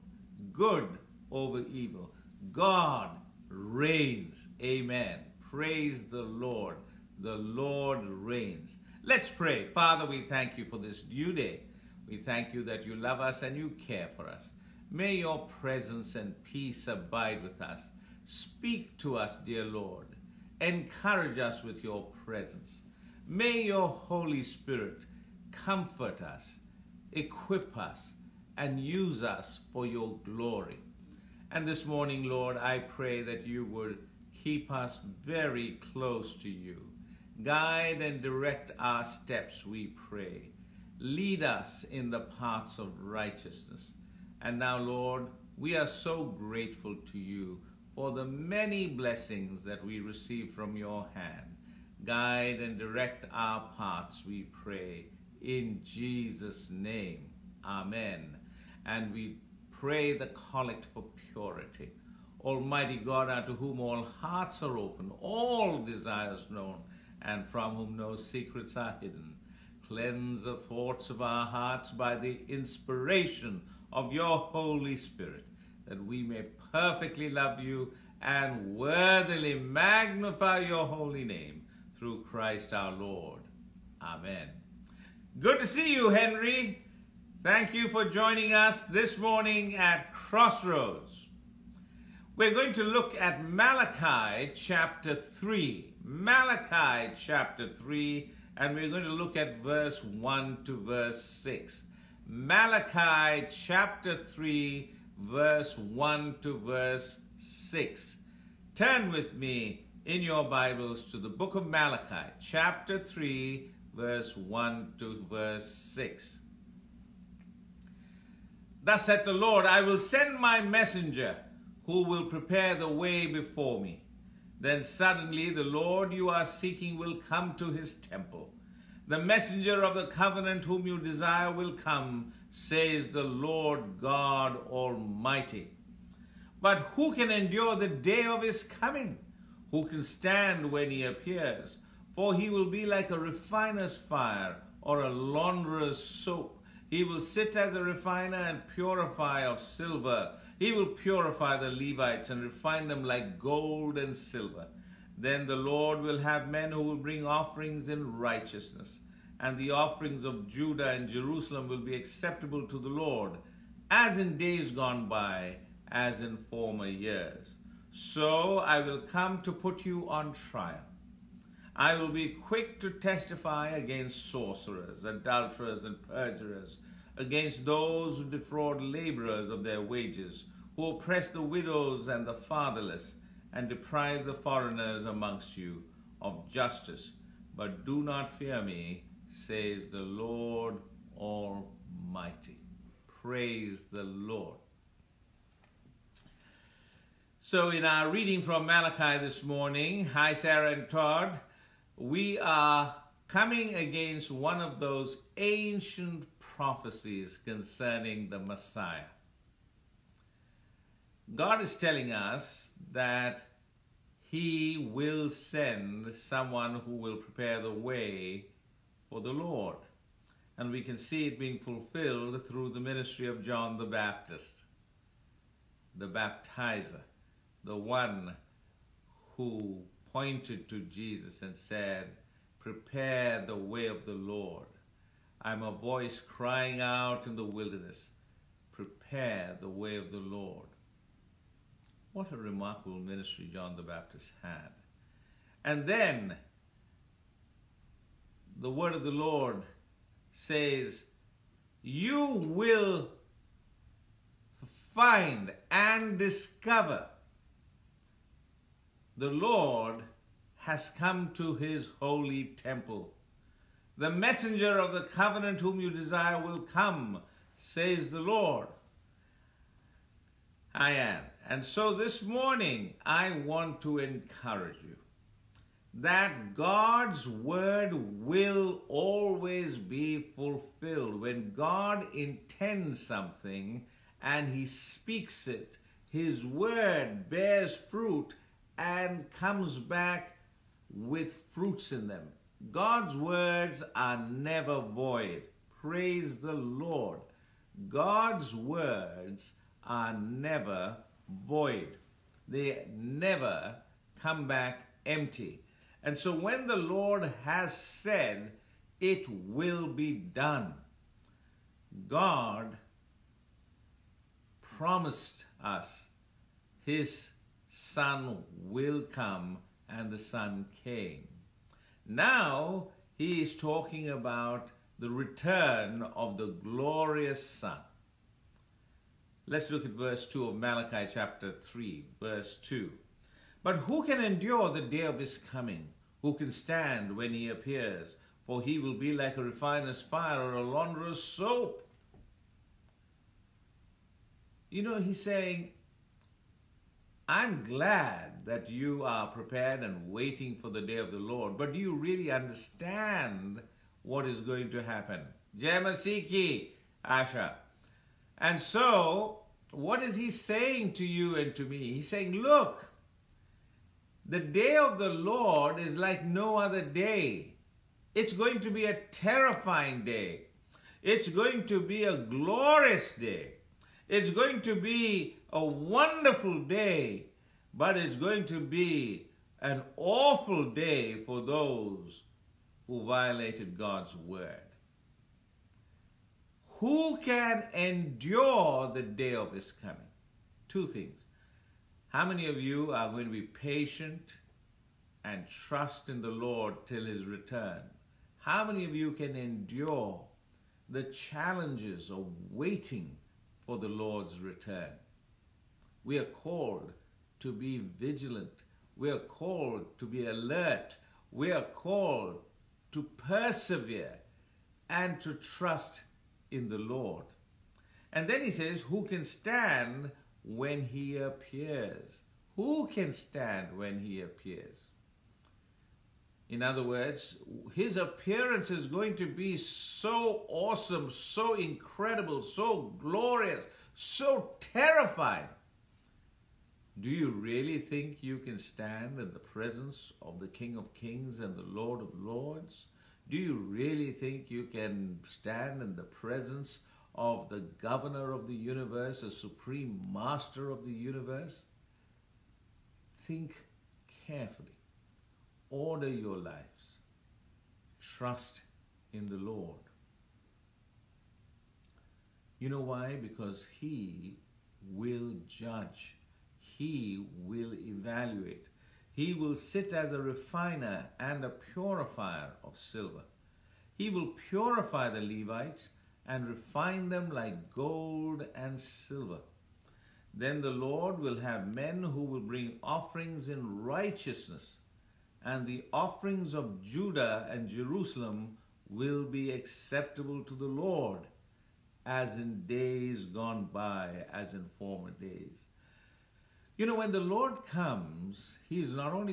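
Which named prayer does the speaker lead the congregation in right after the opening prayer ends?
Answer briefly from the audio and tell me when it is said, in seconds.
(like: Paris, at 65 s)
Collect for purity, at 60 s.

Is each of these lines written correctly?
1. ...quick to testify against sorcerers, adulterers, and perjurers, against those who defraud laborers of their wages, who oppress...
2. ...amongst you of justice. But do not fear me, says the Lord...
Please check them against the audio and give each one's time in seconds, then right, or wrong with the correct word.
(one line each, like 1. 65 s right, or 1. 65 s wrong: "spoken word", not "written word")
1. 172 s right
2. 185 s right.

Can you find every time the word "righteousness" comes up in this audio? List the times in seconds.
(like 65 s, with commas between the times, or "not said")
43 s, 158 s, 483 s.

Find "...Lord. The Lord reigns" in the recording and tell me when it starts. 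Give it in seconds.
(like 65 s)
6 s.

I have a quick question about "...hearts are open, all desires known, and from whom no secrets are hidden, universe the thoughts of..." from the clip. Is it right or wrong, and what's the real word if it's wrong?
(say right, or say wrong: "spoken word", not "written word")
wrong: "cleanse", not "universe".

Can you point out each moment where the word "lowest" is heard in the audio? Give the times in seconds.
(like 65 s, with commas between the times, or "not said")
not said.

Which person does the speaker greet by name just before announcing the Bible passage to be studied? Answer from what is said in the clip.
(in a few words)
Henry.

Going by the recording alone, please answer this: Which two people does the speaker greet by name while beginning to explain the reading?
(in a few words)
Sarah and Todd.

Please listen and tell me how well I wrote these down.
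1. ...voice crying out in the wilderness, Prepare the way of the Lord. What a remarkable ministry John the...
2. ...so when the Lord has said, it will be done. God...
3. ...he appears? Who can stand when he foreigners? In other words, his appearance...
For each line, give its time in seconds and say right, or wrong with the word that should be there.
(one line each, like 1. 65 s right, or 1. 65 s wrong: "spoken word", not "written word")
1. 235 s right
2. 306 s right
3. 420 s wrong: "appears", not "foreigners".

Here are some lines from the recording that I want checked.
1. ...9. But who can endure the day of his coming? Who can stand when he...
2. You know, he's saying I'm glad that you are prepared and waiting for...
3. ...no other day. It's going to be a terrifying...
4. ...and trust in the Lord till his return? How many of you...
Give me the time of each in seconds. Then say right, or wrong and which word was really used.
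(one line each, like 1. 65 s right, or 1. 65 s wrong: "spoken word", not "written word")
1. 332 s wrong: "2", not "9"
2. 344 s right
3. 366 s right
4. 395 s right.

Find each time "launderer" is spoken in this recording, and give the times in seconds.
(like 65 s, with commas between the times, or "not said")
145 s, 340 s.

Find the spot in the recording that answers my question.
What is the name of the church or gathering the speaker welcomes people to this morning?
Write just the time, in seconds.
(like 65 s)
90 s.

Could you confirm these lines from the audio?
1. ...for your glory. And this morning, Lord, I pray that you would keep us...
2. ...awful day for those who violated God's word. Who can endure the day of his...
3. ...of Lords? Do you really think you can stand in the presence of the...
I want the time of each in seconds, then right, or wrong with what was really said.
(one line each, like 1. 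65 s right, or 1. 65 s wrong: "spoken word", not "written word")
1. 29 s right
2. 379 s right
3. 442 s right.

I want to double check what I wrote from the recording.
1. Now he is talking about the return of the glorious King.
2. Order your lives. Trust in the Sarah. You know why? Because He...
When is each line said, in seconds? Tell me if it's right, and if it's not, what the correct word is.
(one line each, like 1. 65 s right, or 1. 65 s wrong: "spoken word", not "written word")
1. 322 s wrong: "Son", not "King"
2. 455 s wrong: "Lord", not "Sarah".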